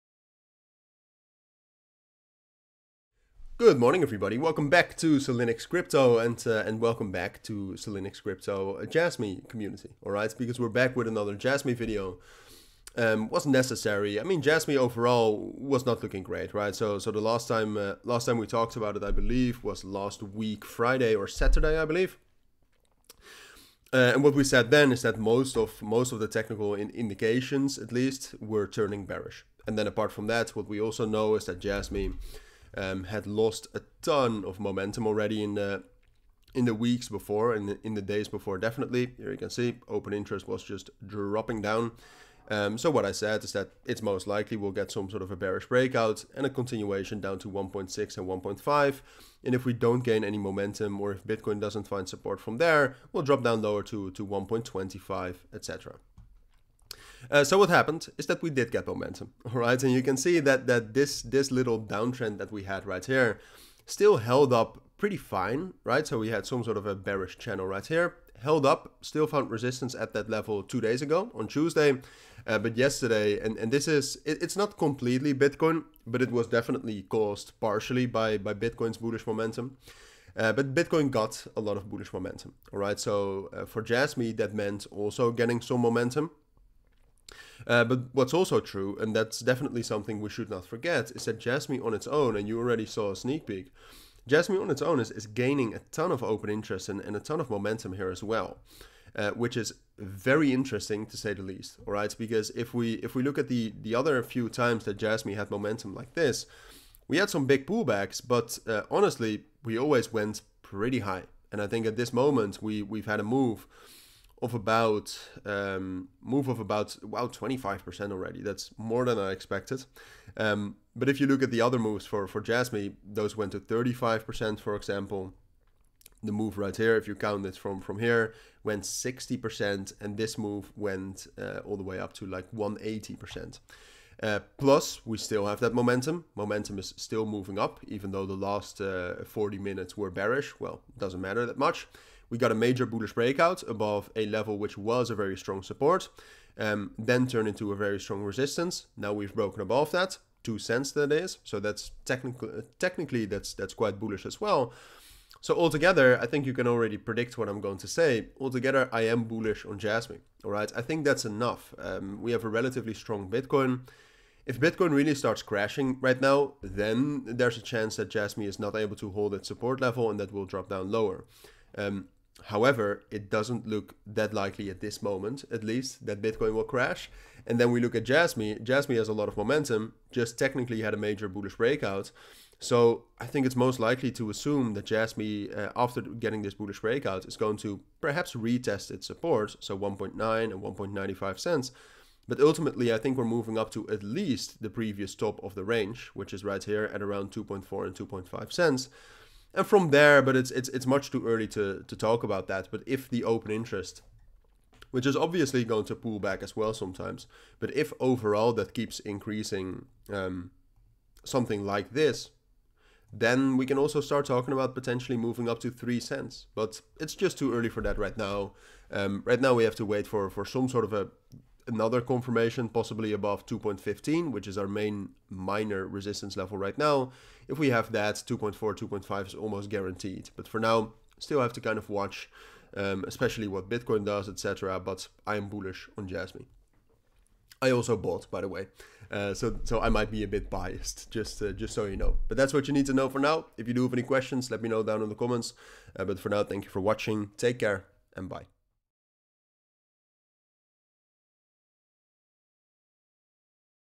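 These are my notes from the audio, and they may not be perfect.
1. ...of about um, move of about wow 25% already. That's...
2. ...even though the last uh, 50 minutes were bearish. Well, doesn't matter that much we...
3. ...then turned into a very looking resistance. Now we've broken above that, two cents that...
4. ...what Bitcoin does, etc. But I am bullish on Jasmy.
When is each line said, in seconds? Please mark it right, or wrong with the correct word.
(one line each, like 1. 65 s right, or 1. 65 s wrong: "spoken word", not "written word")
1. 114 s right
2. 137 s wrong: "40", not "50"
3. 146 s wrong: "strong", not "looking"
4. 233 s right.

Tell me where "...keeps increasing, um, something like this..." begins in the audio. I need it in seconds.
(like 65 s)
208 s.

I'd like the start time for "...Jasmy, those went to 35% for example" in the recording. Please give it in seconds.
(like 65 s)
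122 s.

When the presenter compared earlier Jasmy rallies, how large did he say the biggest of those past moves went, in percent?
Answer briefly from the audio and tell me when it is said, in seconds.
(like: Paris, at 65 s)
180%, at 132 s.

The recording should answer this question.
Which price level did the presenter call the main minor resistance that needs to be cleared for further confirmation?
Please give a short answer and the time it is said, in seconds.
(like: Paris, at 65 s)
2.15, at 223 s.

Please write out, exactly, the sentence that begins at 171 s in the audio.
Um, However, it doesn't look that likely at this moment, at least, that Bitcoin will crash.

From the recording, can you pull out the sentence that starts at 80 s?
Uh, but Bitcoin got a lot of bullish momentum, all right?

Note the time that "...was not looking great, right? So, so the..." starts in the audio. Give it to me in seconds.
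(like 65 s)
15 s.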